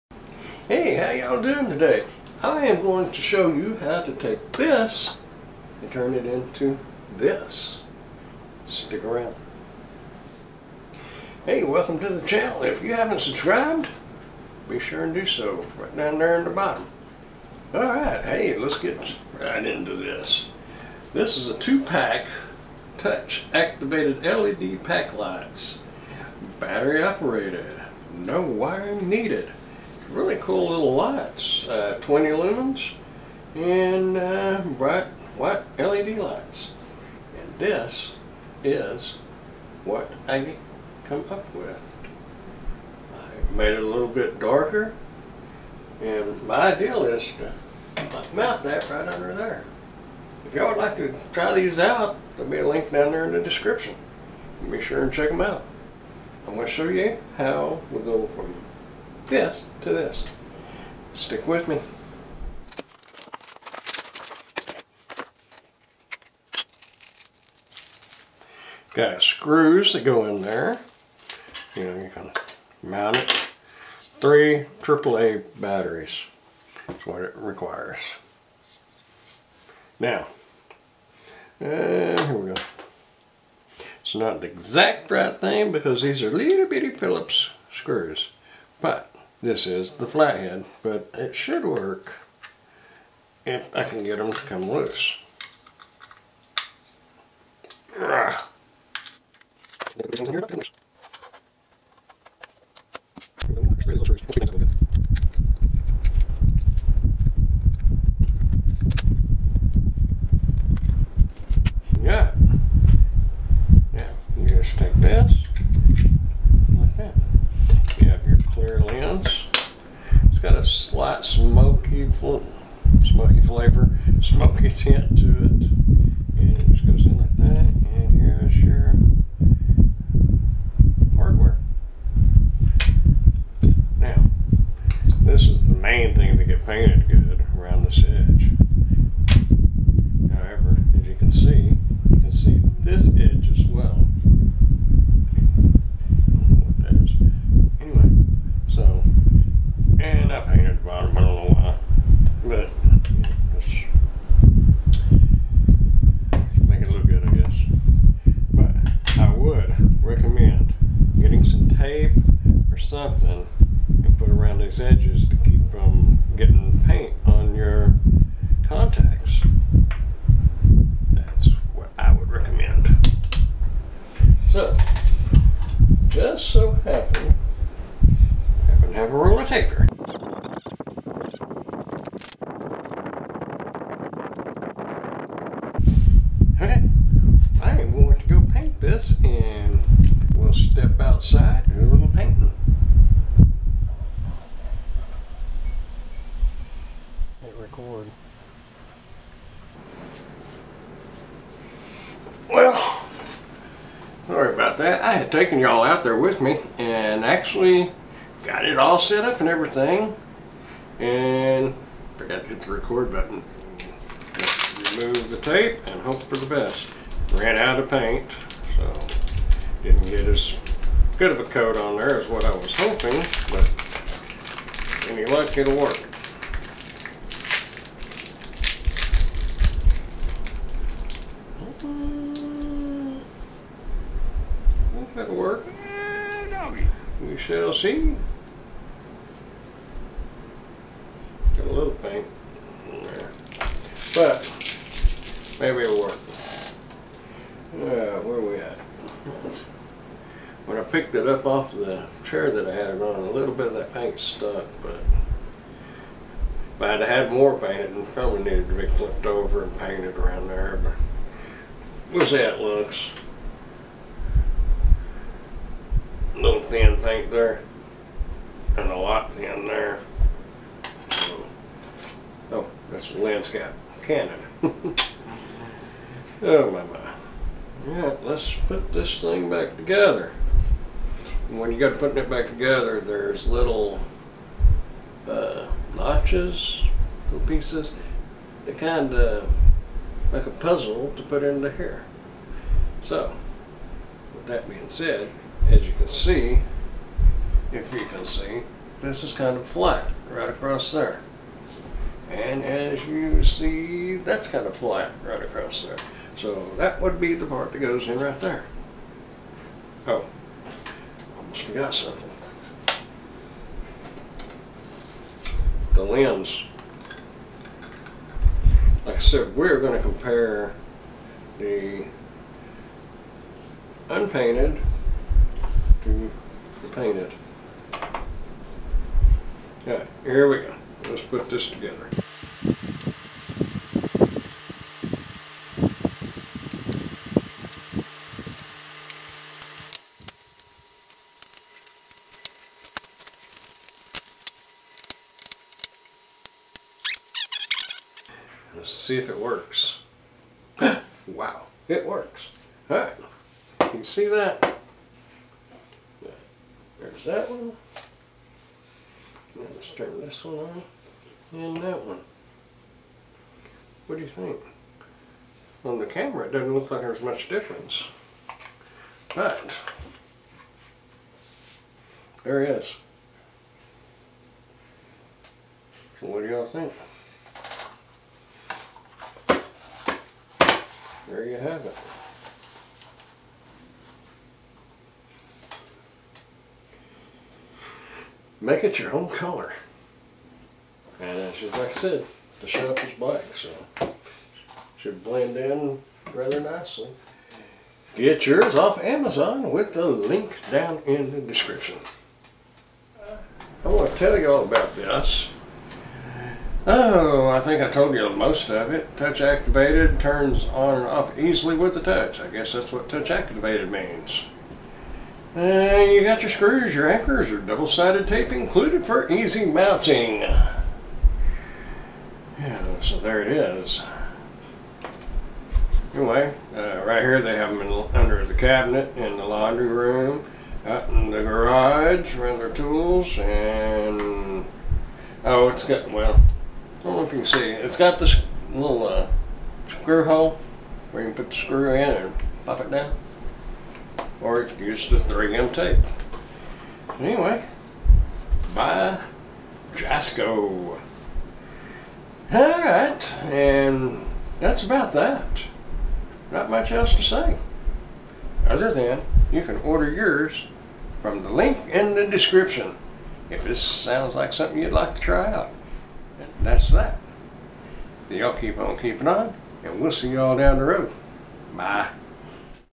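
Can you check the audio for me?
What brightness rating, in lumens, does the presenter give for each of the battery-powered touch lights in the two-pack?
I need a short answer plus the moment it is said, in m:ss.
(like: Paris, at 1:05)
20 lumens, at 0:32.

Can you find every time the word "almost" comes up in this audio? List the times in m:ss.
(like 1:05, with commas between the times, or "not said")
5:11.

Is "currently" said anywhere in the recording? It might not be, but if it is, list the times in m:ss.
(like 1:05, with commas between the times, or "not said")
not said.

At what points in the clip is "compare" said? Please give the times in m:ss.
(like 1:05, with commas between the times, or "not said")
5:20.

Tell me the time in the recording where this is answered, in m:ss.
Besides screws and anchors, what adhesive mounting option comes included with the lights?
6:57.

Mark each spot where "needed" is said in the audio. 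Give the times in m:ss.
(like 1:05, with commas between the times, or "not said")
0:29, 4:18.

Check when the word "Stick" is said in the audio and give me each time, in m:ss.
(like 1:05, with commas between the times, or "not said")
0:08, 1:01.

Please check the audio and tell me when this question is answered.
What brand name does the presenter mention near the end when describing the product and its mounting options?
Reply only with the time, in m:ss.
7:29.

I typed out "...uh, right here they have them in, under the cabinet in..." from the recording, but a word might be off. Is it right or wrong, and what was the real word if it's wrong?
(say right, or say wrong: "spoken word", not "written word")
right.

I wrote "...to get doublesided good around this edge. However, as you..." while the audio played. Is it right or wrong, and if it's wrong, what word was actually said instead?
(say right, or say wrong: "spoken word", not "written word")
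wrong: "painted", not "doublesided".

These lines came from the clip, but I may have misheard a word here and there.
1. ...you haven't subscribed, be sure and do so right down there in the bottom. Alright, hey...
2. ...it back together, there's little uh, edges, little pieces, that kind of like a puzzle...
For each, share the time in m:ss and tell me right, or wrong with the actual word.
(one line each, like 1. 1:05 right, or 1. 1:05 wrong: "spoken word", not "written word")
1. 0:12 right
2. 4:42 wrong: "notches", not "edges".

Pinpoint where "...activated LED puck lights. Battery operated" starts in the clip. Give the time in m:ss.
0:23.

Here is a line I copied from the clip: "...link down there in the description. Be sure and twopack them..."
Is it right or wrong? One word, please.
wrong.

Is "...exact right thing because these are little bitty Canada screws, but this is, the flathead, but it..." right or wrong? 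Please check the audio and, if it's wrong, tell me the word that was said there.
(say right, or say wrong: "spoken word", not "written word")
wrong: "Phillips", not "Canada".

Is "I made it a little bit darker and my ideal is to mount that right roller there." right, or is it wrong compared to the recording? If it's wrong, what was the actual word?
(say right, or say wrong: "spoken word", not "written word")
wrong: "under", not "roller".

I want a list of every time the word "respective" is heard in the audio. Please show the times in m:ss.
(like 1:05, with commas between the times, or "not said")
not said.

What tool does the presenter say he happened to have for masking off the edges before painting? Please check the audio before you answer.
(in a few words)
Roller taper.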